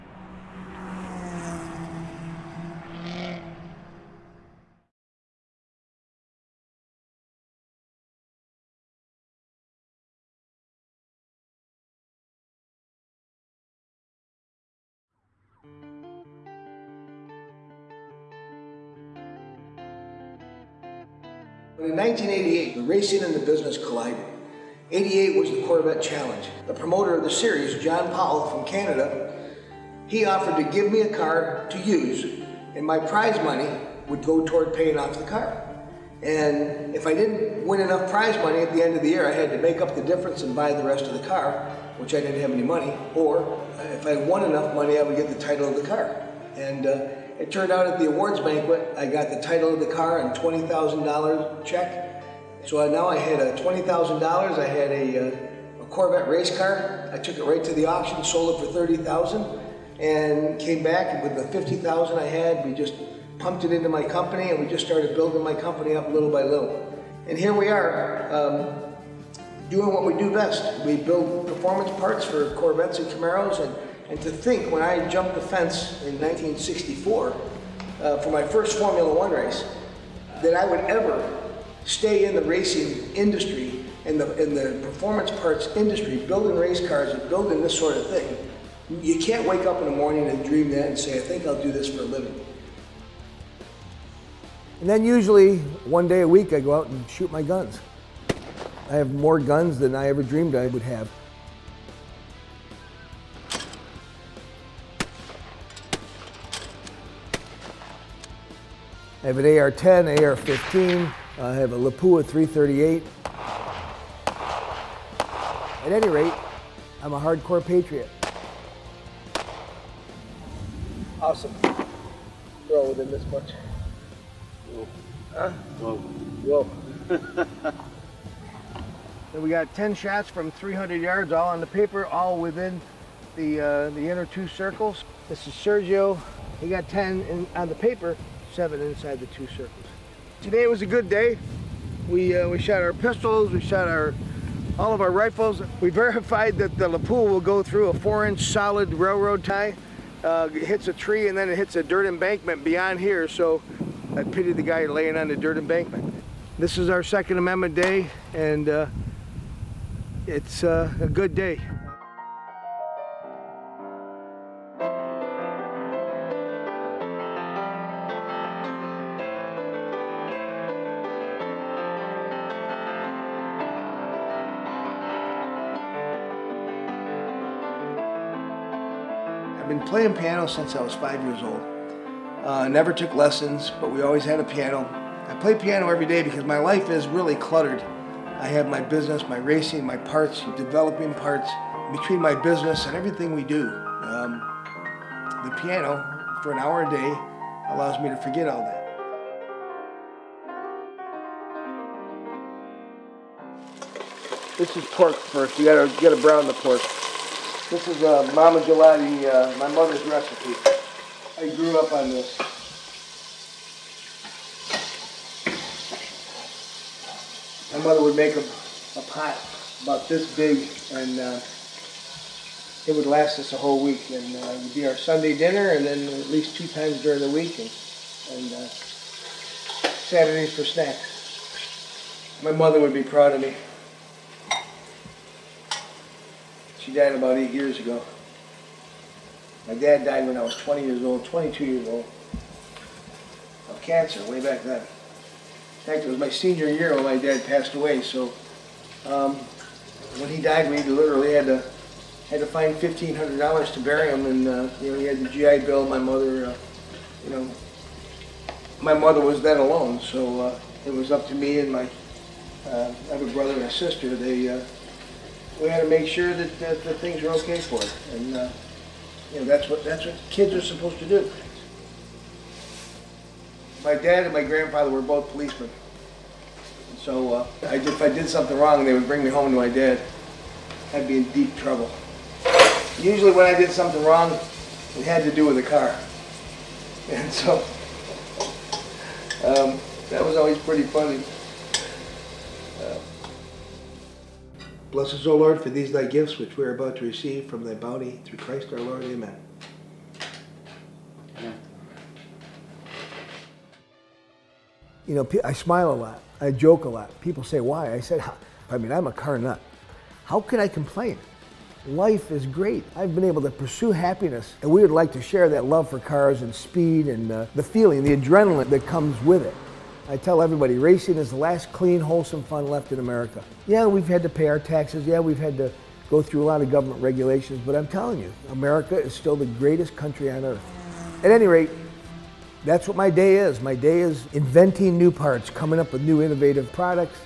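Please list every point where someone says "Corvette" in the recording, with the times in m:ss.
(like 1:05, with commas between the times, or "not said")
0:25, 0:55, 1:12.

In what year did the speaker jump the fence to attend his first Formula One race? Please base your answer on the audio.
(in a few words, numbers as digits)
1964.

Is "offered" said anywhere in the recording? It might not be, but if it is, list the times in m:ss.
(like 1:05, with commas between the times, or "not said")
0:30.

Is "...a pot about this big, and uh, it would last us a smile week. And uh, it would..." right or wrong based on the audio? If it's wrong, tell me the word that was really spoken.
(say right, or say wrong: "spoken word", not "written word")
wrong: "whole", not "smile".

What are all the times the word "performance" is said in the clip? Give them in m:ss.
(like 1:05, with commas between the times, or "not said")
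1:11, 1:24.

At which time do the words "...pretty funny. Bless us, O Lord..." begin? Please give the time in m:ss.
4:50.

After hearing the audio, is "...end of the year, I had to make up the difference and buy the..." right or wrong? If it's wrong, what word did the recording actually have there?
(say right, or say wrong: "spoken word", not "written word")
right.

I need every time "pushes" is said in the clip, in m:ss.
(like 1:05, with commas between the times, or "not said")
not said.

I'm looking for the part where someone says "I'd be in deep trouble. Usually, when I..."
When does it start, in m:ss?
4:40.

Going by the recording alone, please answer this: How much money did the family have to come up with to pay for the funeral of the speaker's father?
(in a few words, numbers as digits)
$1,500.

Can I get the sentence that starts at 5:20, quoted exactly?
I tell everybody, racing is the last clean, wholesome fun left in America.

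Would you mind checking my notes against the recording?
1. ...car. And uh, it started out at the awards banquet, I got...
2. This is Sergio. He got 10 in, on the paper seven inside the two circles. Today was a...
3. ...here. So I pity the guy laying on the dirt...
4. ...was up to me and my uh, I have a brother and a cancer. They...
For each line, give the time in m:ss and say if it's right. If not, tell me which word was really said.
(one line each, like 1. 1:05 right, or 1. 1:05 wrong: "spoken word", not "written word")
1. 0:45 wrong: "turned", not "started"
2. 2:15 right
3. 2:32 right
4. 4:20 wrong: "sister", not "cancer".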